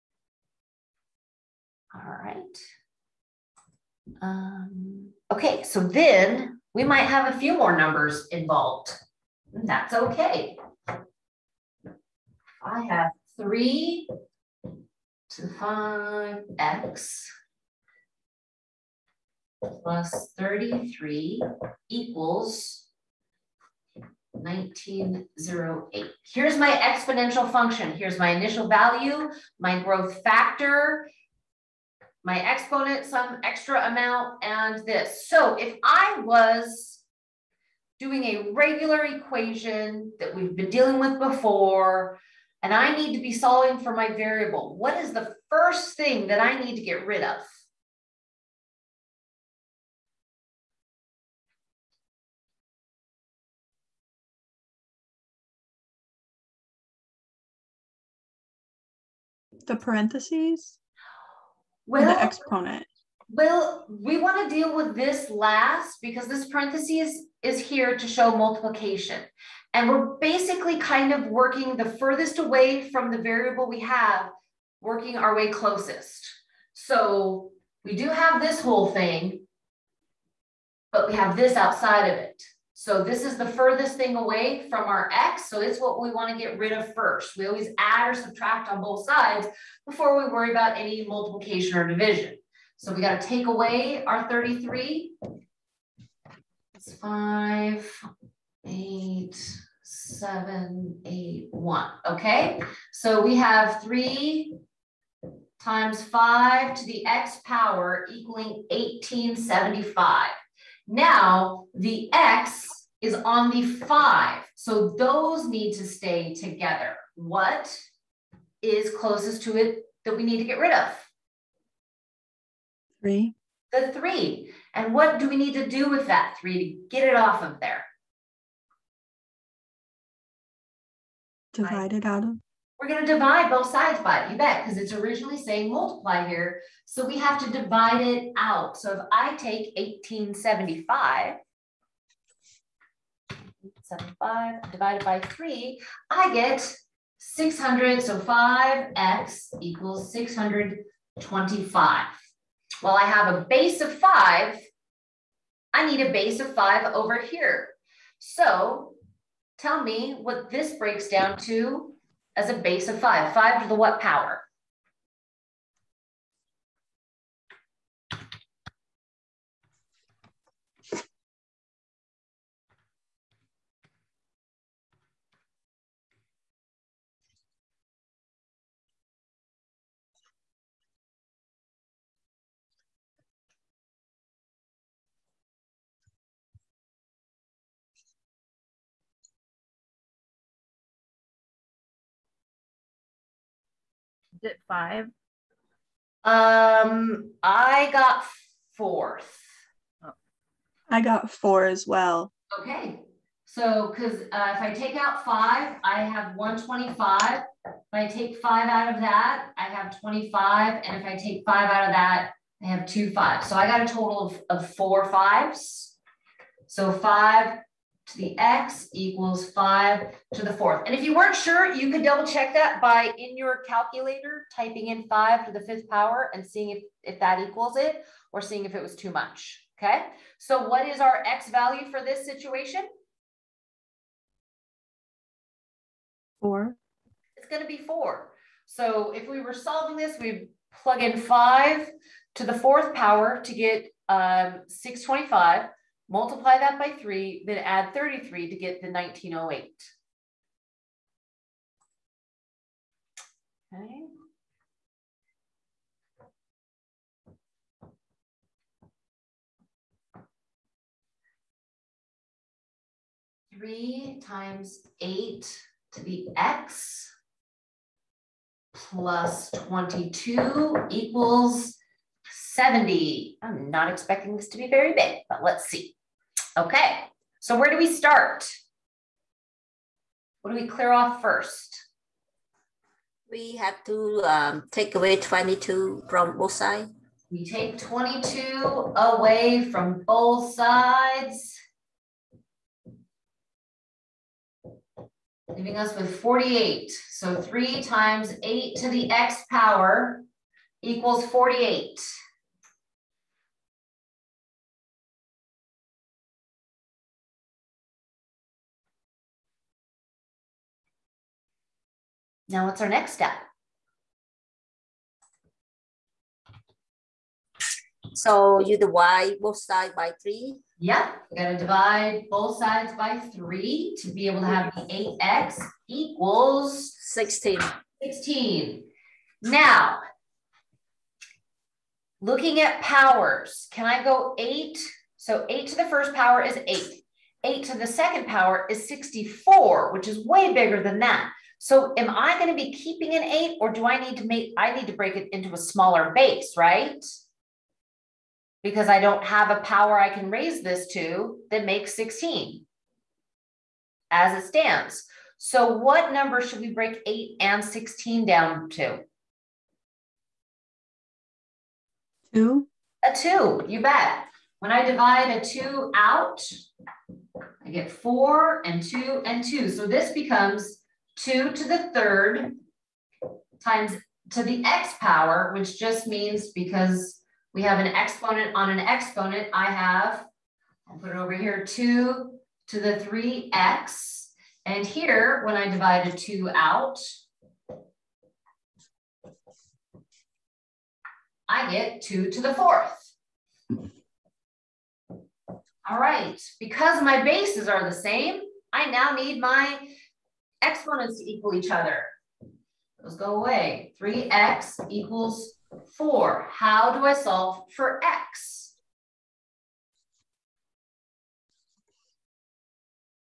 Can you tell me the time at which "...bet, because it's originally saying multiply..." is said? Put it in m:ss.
2:14.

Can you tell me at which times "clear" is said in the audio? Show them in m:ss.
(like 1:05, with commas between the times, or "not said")
4:40.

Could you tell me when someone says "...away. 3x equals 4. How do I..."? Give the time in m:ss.
6:43.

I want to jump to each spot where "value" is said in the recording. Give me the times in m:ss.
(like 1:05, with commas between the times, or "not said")
0:28, 3:51.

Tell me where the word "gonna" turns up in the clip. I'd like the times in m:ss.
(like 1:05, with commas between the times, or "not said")
5:21.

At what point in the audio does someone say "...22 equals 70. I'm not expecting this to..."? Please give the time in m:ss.
4:29.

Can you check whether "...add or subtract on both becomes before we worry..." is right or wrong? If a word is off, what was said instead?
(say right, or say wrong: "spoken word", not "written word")
wrong: "sides", not "becomes".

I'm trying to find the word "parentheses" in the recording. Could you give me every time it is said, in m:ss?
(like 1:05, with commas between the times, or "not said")
0:59, 1:06.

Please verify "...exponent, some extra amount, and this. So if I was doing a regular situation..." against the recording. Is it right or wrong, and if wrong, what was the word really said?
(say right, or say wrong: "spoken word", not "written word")
wrong: "equation", not "situation".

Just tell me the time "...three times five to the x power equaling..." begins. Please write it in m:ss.
1:43.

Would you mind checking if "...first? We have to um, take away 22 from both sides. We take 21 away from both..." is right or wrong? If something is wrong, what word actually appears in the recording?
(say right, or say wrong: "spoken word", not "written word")
wrong: "22", not "21".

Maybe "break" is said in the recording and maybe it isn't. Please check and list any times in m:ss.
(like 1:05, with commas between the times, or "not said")
2:40, 5:44, 5:56.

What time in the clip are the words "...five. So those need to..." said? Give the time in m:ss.
1:53.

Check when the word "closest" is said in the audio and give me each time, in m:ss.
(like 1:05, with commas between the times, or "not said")
1:15, 1:58.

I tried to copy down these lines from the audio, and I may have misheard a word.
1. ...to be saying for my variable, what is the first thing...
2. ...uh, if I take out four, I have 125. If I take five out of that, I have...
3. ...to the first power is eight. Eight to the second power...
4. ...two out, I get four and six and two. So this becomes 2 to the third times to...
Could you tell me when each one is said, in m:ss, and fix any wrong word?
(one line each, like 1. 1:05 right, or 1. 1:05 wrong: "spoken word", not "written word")
1. 0:43 wrong: "solving", not "saying"
2. 3:24 wrong: "five", not "four"
3. 5:35 right
4. 6:05 wrong: "two", not "six".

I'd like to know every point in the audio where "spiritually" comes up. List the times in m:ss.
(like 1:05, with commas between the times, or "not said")
not said.